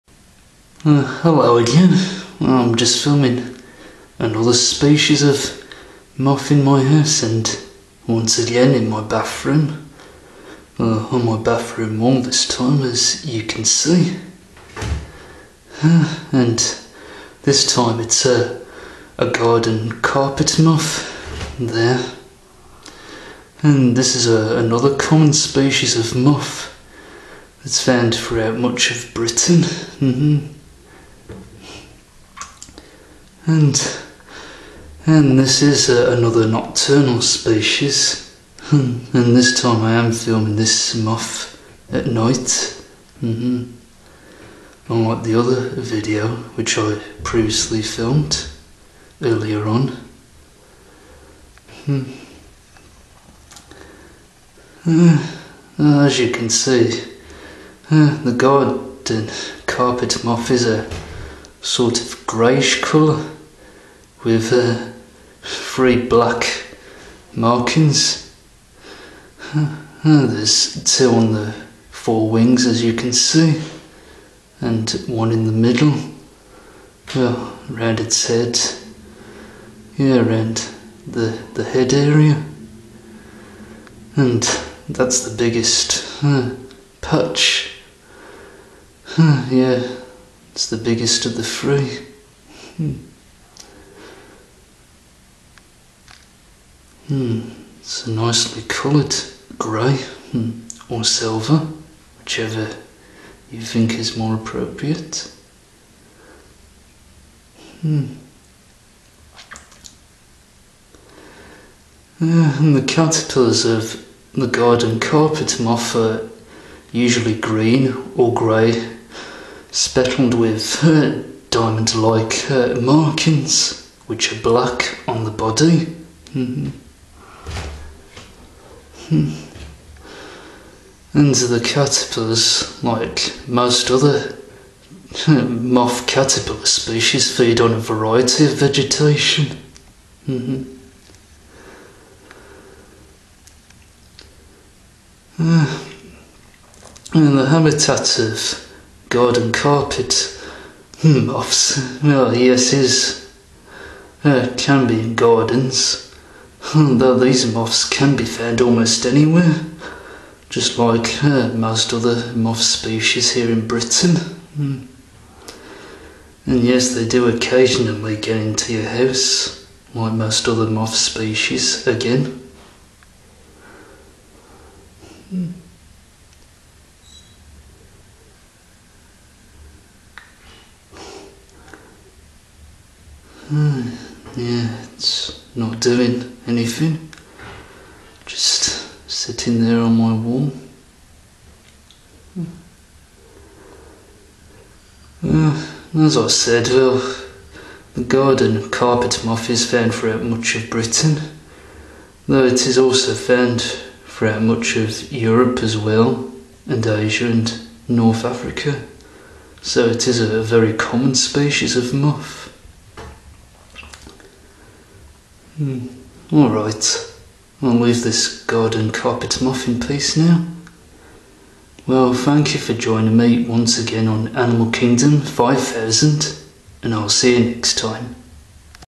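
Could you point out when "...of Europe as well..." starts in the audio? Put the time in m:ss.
3:24.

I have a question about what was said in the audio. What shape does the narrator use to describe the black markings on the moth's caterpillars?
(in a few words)
diamond like.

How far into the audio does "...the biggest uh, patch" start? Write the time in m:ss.
1:25.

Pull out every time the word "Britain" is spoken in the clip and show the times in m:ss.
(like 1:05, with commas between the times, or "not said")
0:29, 2:43, 3:20.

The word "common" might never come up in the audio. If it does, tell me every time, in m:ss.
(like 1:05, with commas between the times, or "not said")
0:24, 3:30.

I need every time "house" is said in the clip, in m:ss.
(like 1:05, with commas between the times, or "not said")
0:06, 2:48.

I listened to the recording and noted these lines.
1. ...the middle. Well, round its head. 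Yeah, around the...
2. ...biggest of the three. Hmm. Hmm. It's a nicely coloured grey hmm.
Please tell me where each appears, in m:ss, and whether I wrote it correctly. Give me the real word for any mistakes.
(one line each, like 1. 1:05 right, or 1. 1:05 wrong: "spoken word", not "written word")
1. 1:15 right
2. 1:30 right.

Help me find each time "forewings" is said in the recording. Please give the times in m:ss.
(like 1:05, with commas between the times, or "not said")
1:11.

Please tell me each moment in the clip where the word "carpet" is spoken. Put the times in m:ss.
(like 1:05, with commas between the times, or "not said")
0:20, 0:59, 1:54, 2:29, 3:18, 3:38.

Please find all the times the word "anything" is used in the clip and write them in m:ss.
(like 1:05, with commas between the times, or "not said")
3:06.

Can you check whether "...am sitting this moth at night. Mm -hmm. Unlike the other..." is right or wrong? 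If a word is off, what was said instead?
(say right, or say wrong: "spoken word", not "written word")
wrong: "filming", not "sitting".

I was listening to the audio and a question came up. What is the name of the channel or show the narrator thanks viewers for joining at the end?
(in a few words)
Animal Kingdom 5000.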